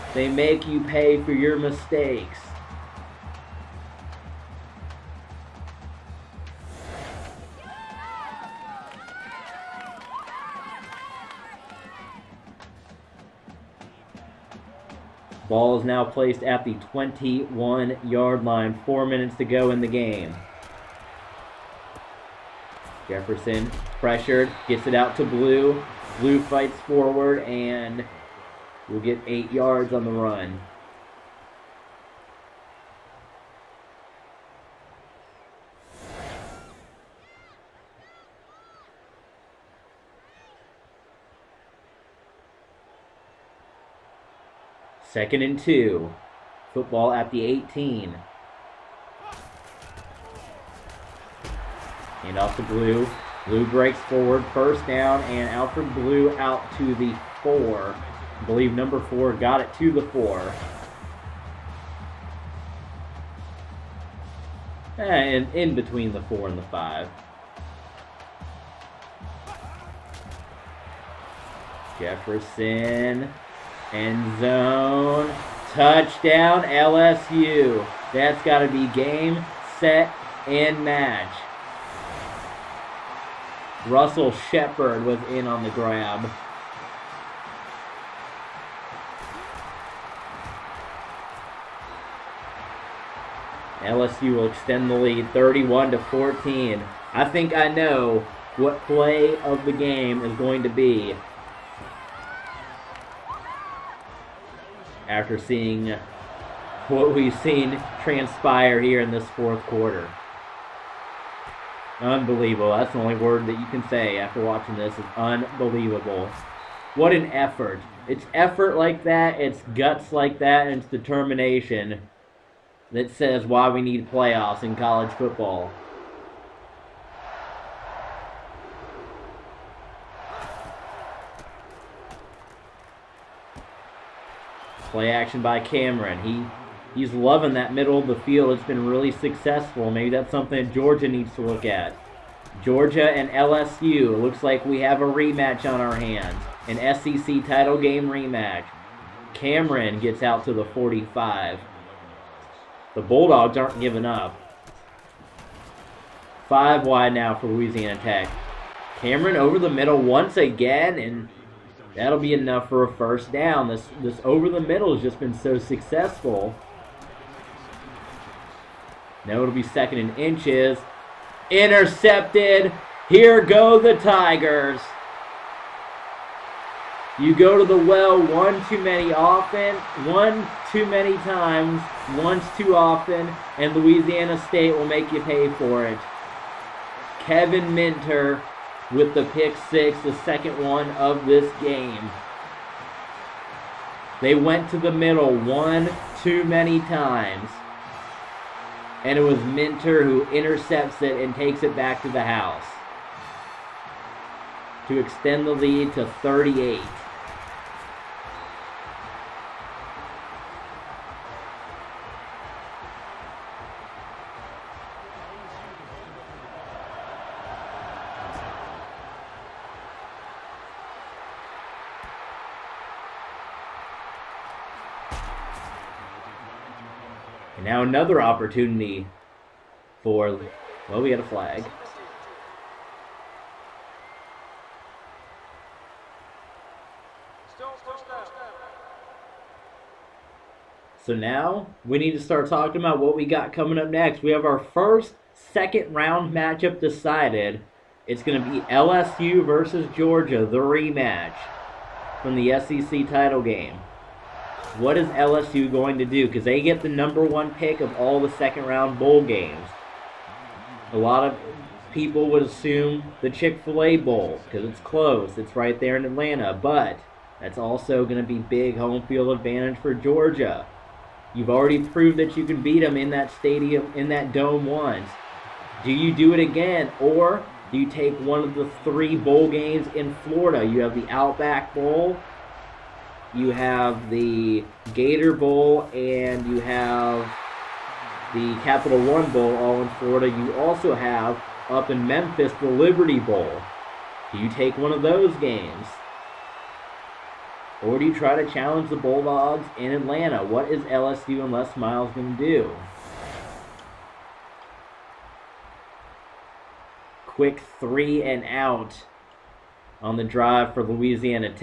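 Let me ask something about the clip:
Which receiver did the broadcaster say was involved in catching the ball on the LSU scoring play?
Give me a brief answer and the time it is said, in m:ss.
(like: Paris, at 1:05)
Russell Shepard, at 1:23.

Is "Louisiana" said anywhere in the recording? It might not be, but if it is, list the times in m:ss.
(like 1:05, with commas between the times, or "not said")
2:37, 3:03, 5:10.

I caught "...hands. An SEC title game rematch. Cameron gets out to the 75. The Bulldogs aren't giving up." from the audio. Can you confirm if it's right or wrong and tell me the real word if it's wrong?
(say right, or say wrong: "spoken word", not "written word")
wrong: "45", not "75".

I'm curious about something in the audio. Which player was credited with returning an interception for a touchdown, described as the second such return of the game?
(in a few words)
Kevin Minter.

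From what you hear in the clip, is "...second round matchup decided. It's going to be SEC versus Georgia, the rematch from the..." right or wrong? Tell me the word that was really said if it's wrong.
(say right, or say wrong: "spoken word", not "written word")
wrong: "LSU", not "SEC".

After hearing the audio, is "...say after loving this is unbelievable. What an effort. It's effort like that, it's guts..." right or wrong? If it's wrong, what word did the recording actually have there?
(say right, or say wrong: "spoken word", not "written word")
wrong: "watching", not "loving".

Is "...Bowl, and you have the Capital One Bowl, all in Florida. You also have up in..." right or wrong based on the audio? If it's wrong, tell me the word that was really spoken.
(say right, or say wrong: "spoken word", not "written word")
right.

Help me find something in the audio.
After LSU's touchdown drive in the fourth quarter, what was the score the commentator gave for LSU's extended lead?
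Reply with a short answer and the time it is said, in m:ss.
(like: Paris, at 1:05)
31 to 14, at 1:35.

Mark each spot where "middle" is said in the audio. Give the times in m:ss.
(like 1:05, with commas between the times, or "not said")
2:17, 2:39, 2:44, 3:14.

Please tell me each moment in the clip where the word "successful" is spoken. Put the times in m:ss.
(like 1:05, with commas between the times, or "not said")
2:19, 2:45.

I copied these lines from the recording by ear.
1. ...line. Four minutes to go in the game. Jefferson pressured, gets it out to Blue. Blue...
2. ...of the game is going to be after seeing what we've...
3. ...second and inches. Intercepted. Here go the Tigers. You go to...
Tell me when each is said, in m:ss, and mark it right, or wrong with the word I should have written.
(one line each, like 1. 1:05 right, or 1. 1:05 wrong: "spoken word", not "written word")
1. 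0:18 right
2. 1:39 right
3. 2:49 right.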